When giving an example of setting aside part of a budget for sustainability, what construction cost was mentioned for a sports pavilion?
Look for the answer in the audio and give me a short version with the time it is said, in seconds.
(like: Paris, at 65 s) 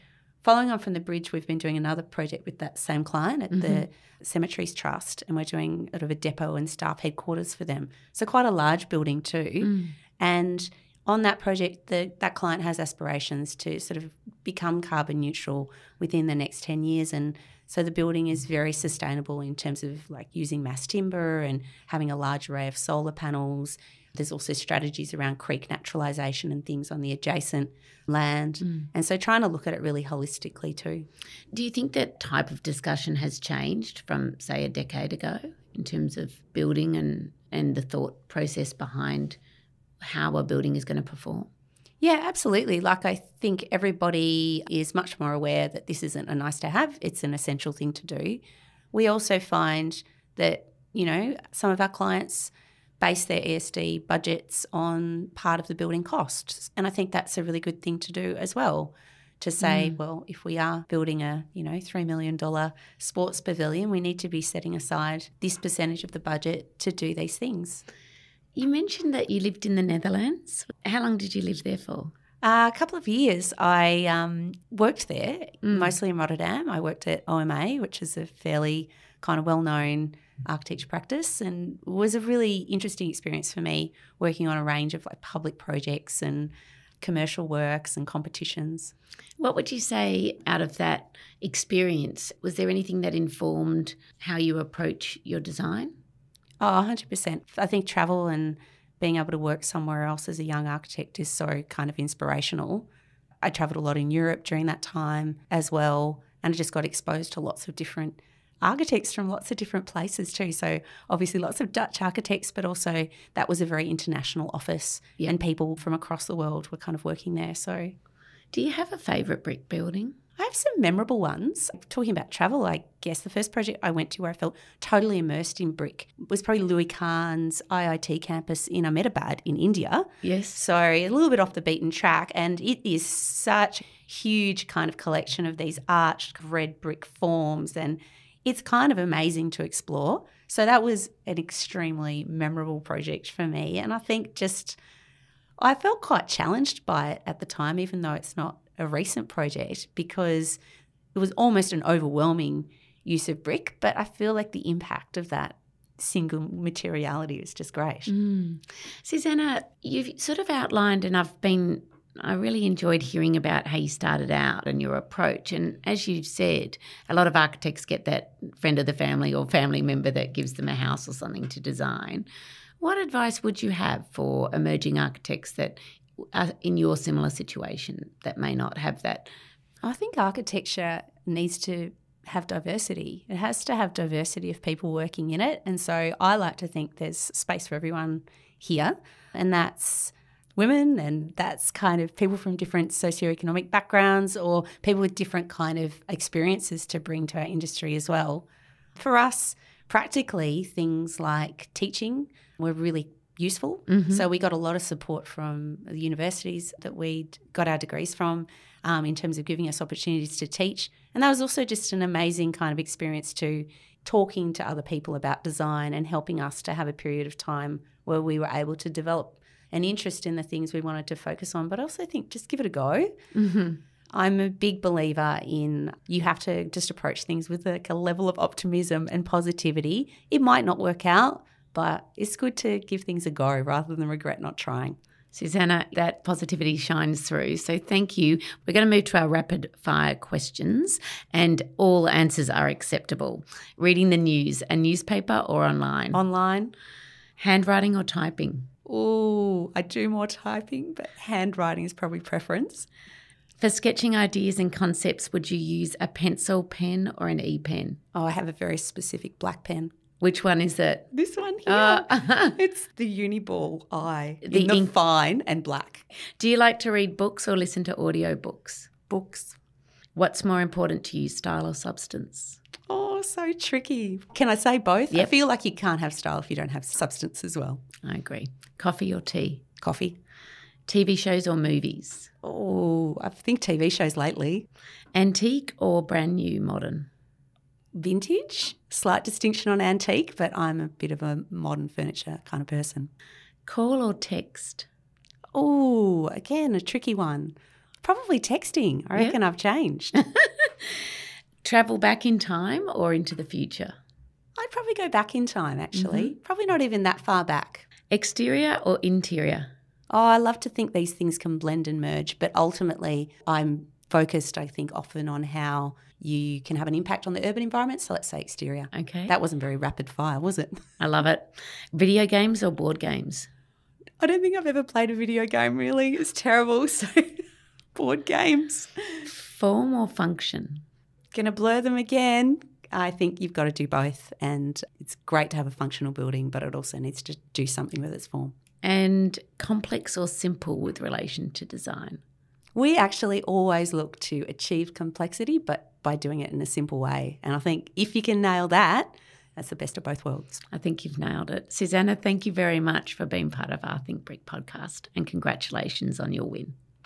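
$3 million, at 61 s.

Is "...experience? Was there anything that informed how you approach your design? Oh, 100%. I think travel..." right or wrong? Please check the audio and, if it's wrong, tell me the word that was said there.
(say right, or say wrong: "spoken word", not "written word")
right.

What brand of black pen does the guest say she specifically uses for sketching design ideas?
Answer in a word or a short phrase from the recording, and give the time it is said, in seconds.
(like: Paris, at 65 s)
Uniball Eye, at 263 s.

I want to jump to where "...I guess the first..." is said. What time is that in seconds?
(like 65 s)
122 s.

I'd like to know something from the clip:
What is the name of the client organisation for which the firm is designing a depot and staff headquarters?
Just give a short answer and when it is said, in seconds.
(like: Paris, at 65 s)
The Cemeteries Trust, at 3 s.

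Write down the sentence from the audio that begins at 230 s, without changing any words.
It might not work out, but it's good to give things a go rather than regret not trying.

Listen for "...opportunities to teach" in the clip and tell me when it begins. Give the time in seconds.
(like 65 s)
209 s.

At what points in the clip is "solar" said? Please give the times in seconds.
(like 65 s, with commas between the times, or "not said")
22 s.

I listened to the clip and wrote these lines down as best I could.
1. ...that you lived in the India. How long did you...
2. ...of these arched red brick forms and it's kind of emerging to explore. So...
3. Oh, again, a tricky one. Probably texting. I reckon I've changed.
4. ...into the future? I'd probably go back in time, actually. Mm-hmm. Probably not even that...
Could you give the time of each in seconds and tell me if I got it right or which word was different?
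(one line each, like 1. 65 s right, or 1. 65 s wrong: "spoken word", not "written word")
1. 69 s wrong: "Netherlands", not "India"
2. 135 s wrong: "amazing", not "emerging"
3. 295 s right
4. 303 s right.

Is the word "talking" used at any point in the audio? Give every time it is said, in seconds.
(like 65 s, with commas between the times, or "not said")
121 s, 214 s.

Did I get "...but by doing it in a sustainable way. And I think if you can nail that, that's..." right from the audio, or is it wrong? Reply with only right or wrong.
wrong.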